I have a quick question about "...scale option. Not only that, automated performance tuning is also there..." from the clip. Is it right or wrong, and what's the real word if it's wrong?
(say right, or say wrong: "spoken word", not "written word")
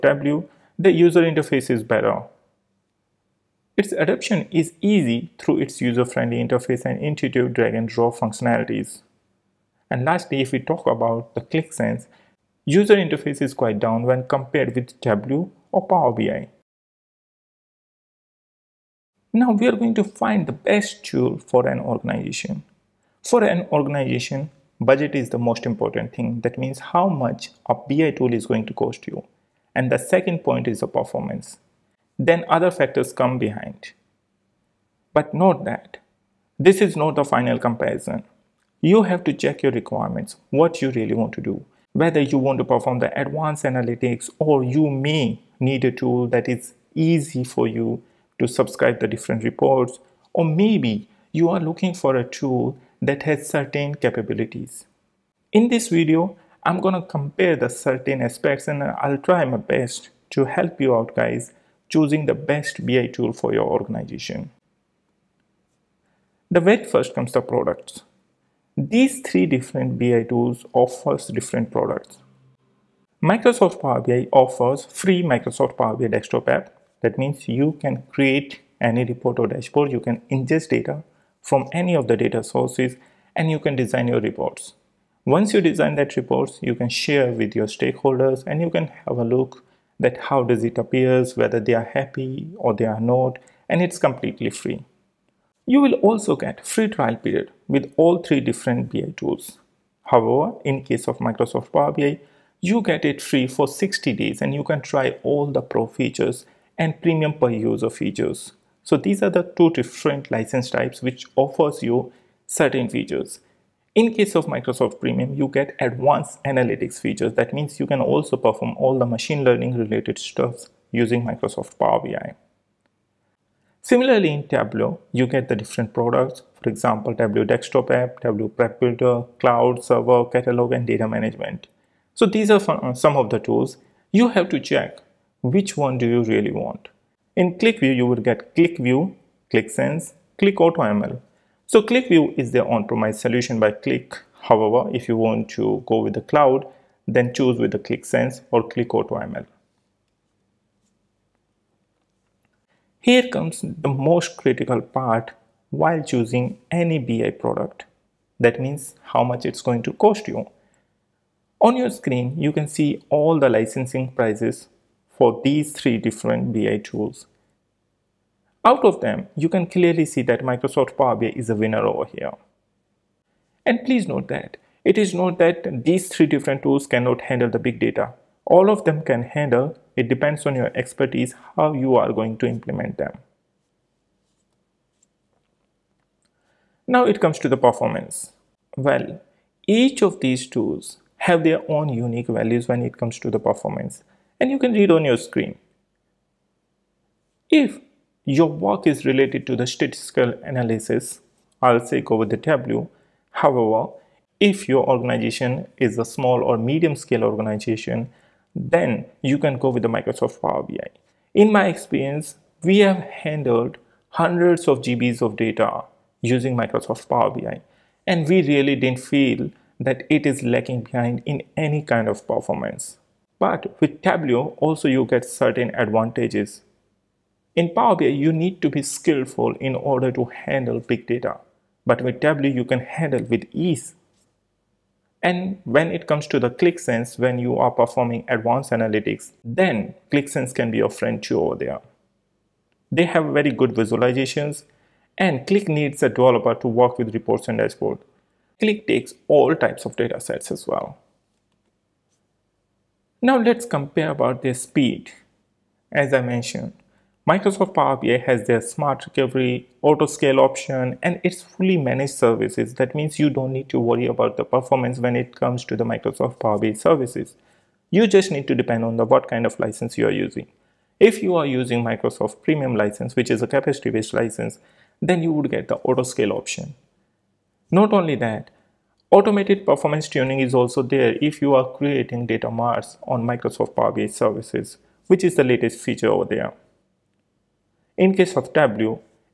right.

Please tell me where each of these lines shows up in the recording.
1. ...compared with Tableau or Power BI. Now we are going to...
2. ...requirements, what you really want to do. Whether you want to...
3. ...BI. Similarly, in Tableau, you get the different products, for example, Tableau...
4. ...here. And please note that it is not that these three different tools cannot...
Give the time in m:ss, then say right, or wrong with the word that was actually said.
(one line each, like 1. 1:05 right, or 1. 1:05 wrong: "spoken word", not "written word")
1. 0:14 right
2. 0:39 right
3. 2:01 right
4. 2:52 right.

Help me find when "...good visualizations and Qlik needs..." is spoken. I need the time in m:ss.
4:03.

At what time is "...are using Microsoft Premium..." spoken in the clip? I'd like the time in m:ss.
4:31.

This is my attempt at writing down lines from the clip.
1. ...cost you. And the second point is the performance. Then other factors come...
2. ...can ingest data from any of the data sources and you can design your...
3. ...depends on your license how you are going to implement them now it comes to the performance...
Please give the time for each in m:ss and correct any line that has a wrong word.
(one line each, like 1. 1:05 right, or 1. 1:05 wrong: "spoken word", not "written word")
1. 0:28 right
2. 1:19 right
3. 3:00 wrong: "expertise", not "license".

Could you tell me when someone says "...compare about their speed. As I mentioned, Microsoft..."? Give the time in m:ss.
4:13.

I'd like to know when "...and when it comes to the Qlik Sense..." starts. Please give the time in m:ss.
3:55.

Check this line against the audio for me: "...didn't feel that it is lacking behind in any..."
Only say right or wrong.
right.